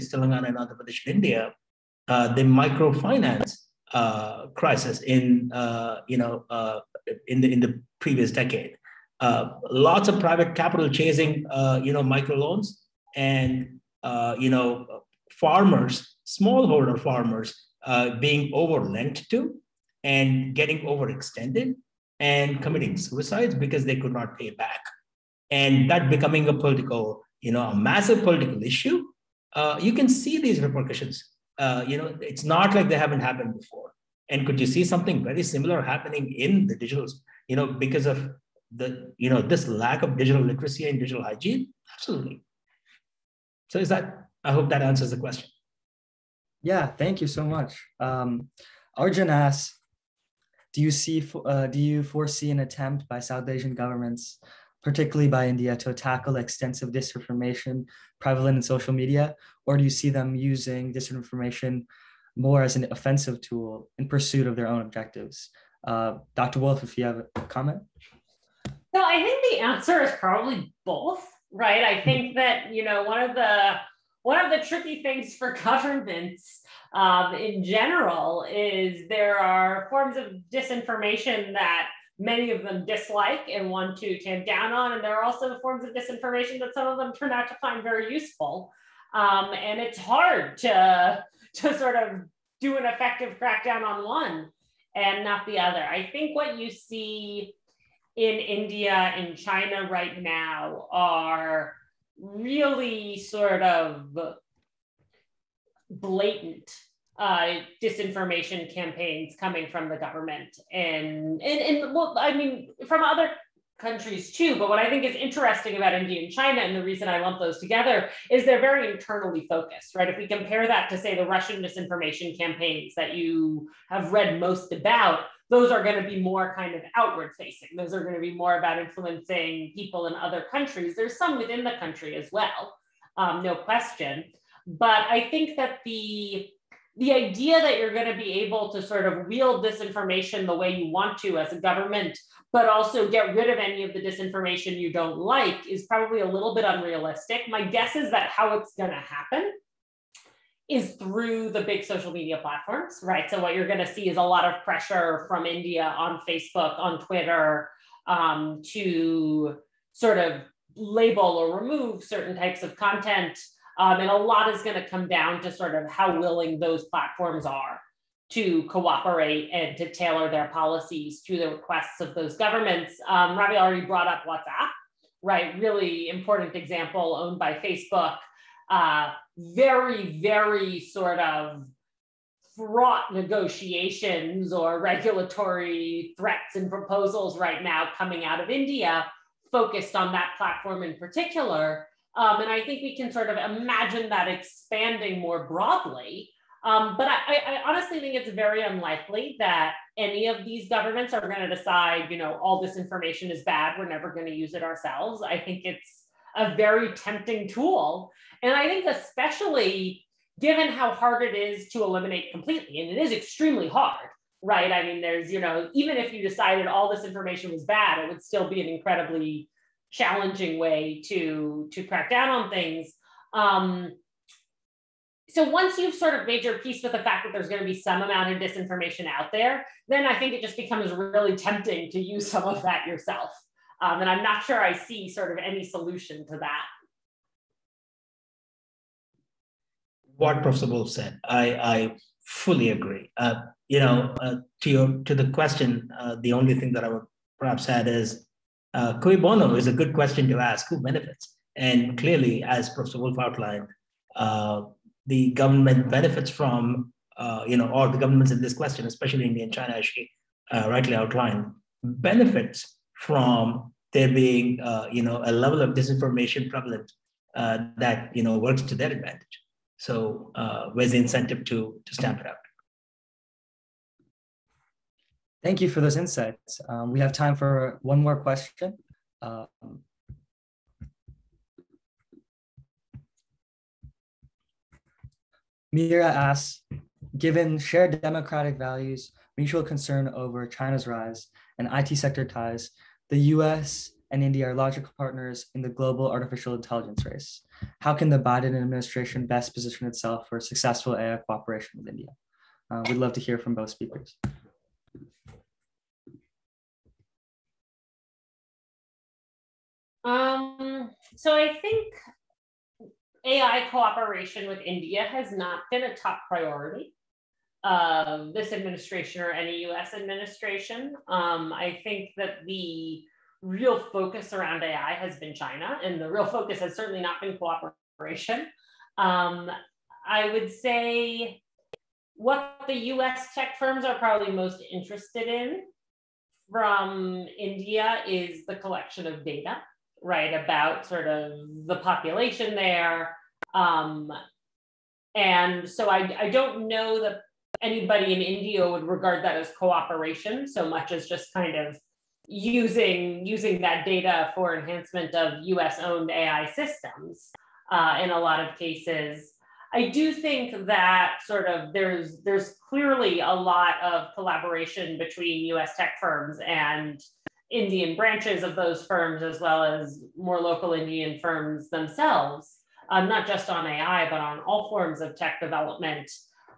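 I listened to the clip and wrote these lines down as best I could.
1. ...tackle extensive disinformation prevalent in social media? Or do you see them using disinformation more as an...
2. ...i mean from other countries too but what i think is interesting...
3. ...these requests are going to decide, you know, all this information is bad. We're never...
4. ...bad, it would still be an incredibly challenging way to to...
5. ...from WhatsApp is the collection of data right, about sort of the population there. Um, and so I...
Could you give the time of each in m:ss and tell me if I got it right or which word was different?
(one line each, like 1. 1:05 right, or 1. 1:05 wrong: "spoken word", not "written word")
1. 0:55 right
2. 1:52 right
3. 3:20 wrong: "governments", not "requests"
4. 3:37 right
5. 5:36 wrong: "India", not "WhatsApp".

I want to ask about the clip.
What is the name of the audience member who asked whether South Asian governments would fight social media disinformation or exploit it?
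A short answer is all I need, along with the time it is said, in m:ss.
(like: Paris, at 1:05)
Arjun, at 0:48.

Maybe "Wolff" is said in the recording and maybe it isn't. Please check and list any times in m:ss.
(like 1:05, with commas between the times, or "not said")
1:06, 4:00, 4:12.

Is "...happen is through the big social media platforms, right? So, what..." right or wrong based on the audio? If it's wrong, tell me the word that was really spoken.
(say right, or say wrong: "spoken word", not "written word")
right.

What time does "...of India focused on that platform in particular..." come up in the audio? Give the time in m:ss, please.
3:08.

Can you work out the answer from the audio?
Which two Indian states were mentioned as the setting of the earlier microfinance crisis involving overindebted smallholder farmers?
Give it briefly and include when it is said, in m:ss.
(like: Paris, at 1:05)
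Telangana and Andhra Pradesh, at 0:00.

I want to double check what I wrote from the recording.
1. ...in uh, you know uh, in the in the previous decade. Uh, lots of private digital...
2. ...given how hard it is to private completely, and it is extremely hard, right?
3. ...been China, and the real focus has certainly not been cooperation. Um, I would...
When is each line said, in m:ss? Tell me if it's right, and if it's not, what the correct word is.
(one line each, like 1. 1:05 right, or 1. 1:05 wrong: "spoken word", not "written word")
1. 0:05 wrong: "capital", not "digital"
2. 3:30 wrong: "eliminate", not "private"
3. 5:25 right.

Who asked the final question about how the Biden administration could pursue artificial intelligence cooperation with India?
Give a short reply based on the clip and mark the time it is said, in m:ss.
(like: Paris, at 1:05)
Mira, at 4:45.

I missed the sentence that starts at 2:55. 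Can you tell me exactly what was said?
Really important example owned by Facebook.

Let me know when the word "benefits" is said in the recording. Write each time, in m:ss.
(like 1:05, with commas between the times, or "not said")
4:10, 4:15, 4:21.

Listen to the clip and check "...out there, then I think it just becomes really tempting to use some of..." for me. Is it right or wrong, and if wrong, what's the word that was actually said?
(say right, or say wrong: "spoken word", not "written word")
right.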